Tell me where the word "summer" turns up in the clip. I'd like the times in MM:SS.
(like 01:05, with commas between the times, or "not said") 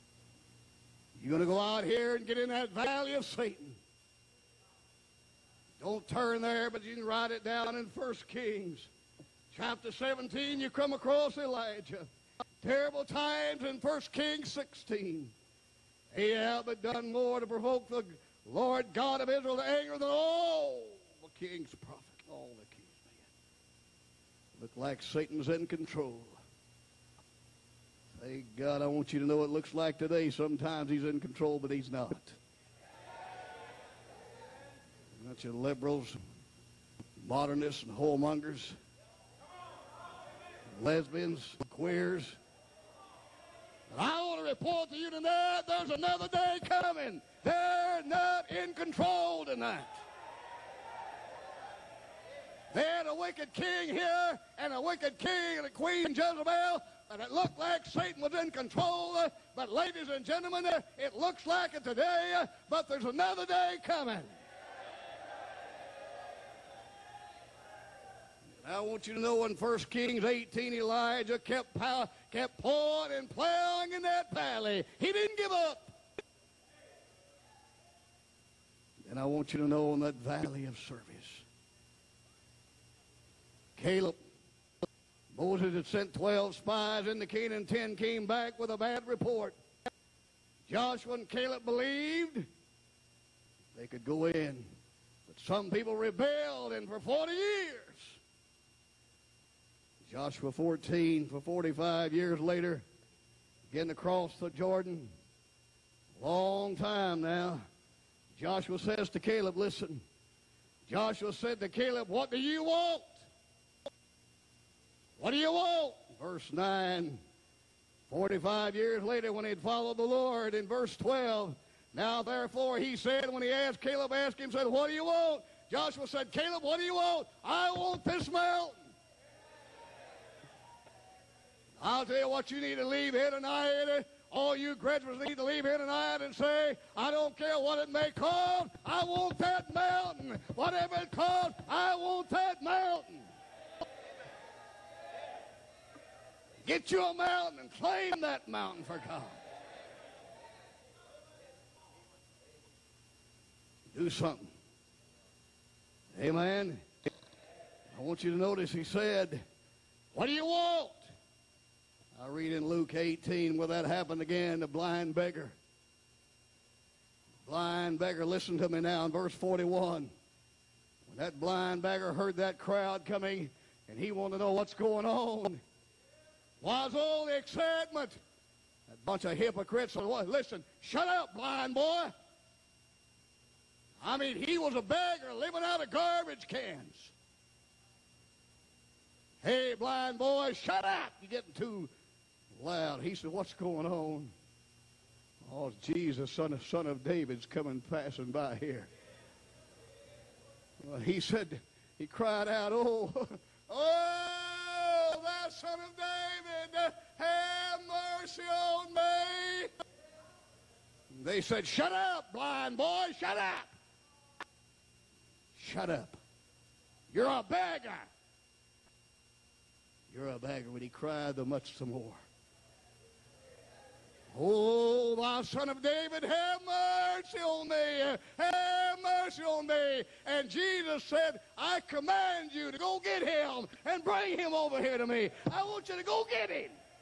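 not said.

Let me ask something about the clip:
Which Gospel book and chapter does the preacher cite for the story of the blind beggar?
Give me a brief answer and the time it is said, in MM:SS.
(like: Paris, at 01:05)
Luke 18, at 02:42.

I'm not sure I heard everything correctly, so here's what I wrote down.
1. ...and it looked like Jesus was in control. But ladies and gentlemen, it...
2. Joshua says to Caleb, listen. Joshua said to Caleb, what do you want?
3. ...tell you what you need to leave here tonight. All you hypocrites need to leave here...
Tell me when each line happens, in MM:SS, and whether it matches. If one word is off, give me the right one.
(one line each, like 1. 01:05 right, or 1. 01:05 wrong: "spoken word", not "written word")
1. 00:57 wrong: "Satan", not "Jesus"
2. 01:48 right
3. 02:12 wrong: "graduates", not "hypocrites".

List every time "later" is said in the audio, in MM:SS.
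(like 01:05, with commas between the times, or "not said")
01:42, 01:59.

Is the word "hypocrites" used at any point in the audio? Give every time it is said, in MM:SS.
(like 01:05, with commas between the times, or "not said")
02:59.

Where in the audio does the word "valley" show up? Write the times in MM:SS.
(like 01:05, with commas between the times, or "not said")
00:02, 01:14, 01:20.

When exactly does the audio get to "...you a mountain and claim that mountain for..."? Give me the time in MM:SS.
02:26.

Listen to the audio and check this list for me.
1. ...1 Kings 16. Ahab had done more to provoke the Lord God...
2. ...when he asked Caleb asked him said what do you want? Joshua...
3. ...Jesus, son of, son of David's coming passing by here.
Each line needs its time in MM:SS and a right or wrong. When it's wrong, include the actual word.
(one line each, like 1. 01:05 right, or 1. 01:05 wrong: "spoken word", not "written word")
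1. 00:13 right
2. 02:03 right
3. 03:15 right.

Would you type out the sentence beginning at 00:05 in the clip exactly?
Don't turn there, but you can write it down in 1 Kings.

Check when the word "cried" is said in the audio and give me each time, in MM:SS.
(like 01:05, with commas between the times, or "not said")
03:22, 03:40.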